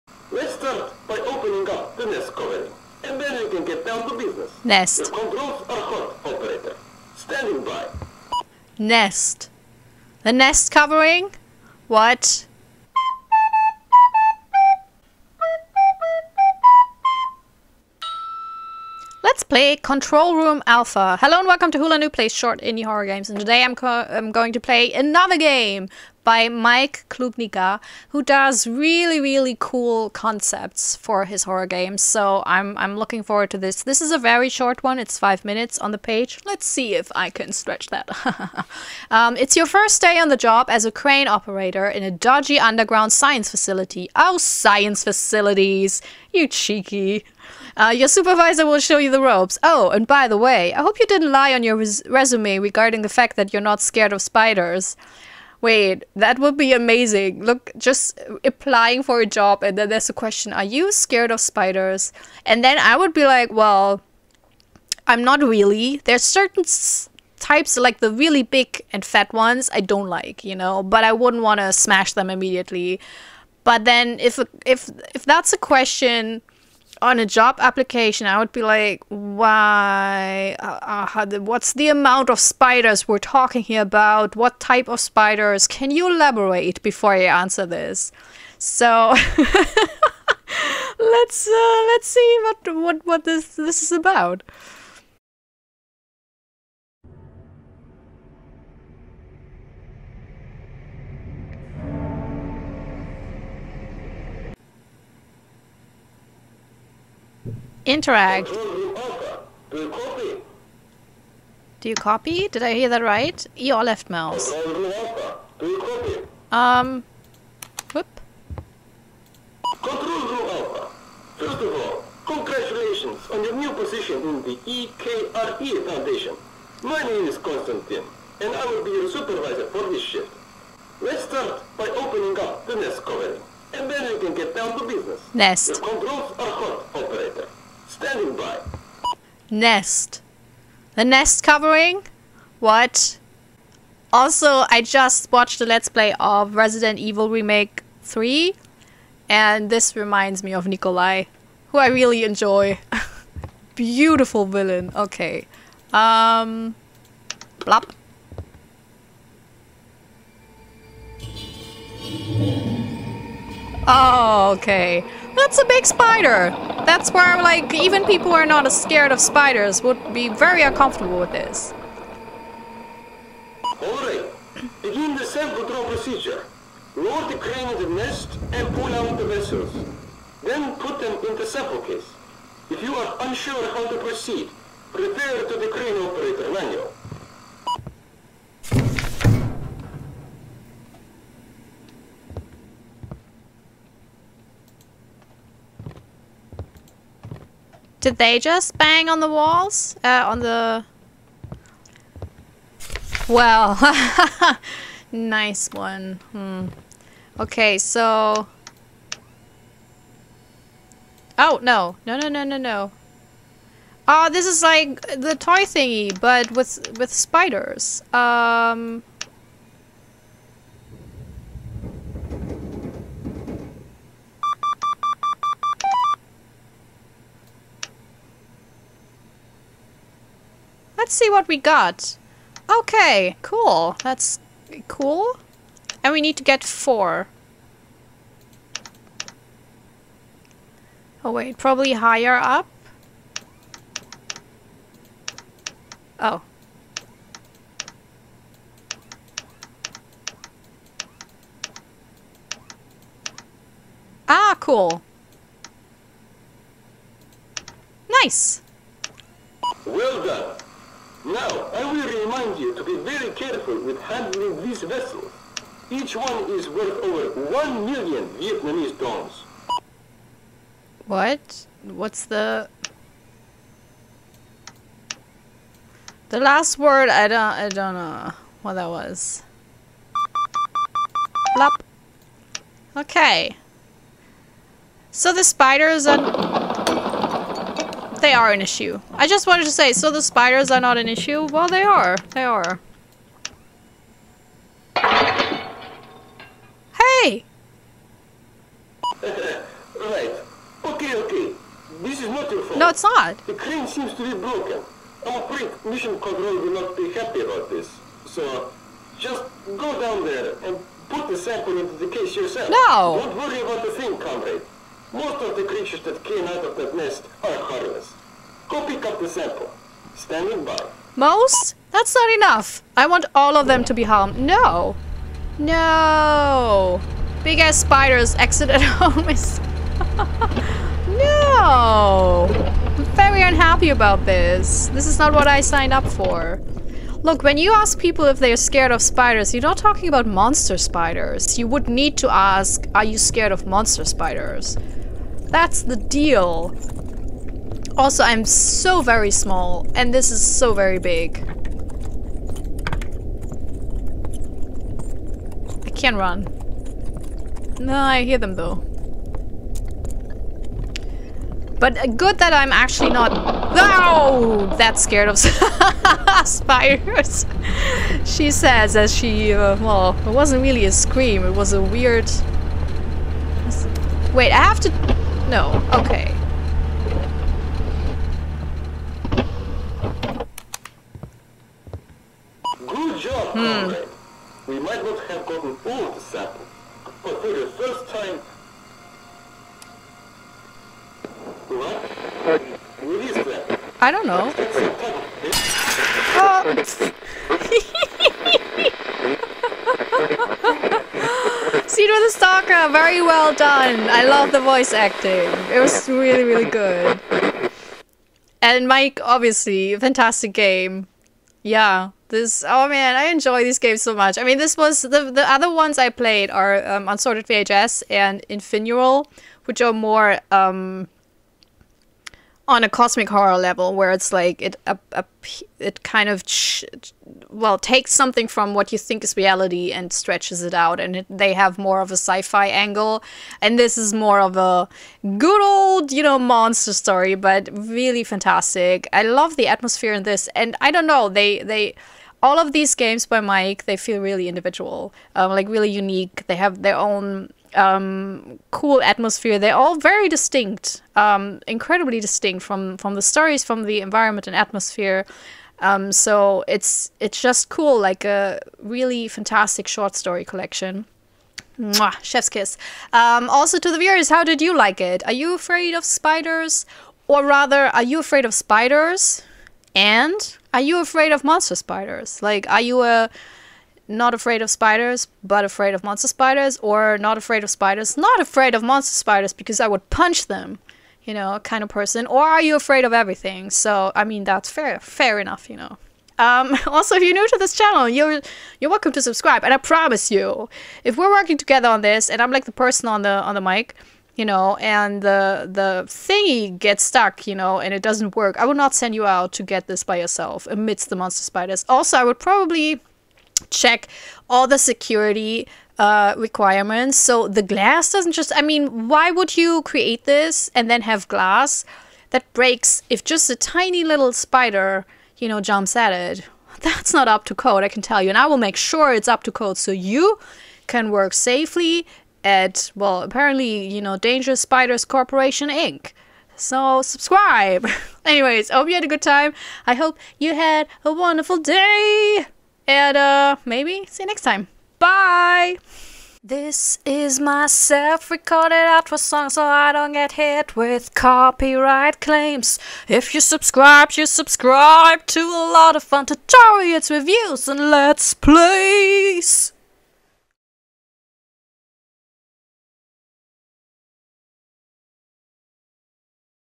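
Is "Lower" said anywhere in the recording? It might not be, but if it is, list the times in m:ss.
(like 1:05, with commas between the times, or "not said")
2:56.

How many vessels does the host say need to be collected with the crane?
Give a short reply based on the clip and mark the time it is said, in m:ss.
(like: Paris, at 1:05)
4, at 3:56.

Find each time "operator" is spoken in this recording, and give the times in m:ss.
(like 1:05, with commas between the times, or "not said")
0:06, 0:41, 2:16, 3:06.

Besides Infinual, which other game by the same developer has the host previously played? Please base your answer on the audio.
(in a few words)
Unsorted VHS.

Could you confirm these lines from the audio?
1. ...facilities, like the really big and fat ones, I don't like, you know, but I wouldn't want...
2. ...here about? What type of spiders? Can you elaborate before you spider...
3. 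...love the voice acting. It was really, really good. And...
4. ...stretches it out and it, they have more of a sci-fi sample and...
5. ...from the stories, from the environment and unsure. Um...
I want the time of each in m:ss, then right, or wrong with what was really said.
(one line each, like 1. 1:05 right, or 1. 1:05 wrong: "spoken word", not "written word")
1. 1:07 wrong: "types", not "facilities"
2. 1:23 wrong: "answer", not "spider"
3. 6:44 right
4. 7:10 wrong: "angle", not "sample"
5. 7:32 wrong: "atmosphere", not "unsure".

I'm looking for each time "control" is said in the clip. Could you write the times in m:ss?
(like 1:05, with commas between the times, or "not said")
0:05, 0:19, 1:59, 2:15, 2:55, 5:06.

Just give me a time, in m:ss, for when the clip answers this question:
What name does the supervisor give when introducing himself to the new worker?
2:07.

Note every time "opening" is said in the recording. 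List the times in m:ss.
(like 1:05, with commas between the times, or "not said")
0:01, 2:11.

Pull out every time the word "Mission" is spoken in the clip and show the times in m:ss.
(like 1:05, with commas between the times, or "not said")
5:05.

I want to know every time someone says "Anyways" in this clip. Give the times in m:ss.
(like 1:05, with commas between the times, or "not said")
8:48.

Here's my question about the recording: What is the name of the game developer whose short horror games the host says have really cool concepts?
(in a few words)
Mike Klubnika.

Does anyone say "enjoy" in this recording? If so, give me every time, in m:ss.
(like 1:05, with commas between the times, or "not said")
2:32, 6:53.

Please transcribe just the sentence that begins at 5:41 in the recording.
You would need to ask, are you scared of monster spiders?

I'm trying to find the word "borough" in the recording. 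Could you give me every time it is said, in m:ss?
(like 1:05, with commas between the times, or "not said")
not said.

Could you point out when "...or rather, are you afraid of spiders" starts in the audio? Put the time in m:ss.
7:47.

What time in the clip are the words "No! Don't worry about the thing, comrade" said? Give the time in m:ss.
5:12.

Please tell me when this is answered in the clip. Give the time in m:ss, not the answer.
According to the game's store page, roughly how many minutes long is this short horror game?
0:35.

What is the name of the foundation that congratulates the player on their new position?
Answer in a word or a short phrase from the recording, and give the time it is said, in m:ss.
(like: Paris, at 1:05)
EKRE Foundation, at 2:04.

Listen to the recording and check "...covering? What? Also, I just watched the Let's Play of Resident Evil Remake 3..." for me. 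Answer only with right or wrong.
right.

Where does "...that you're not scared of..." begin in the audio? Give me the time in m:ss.
0:53.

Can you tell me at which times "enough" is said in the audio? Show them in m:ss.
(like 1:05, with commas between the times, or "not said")
5:22, 8:05.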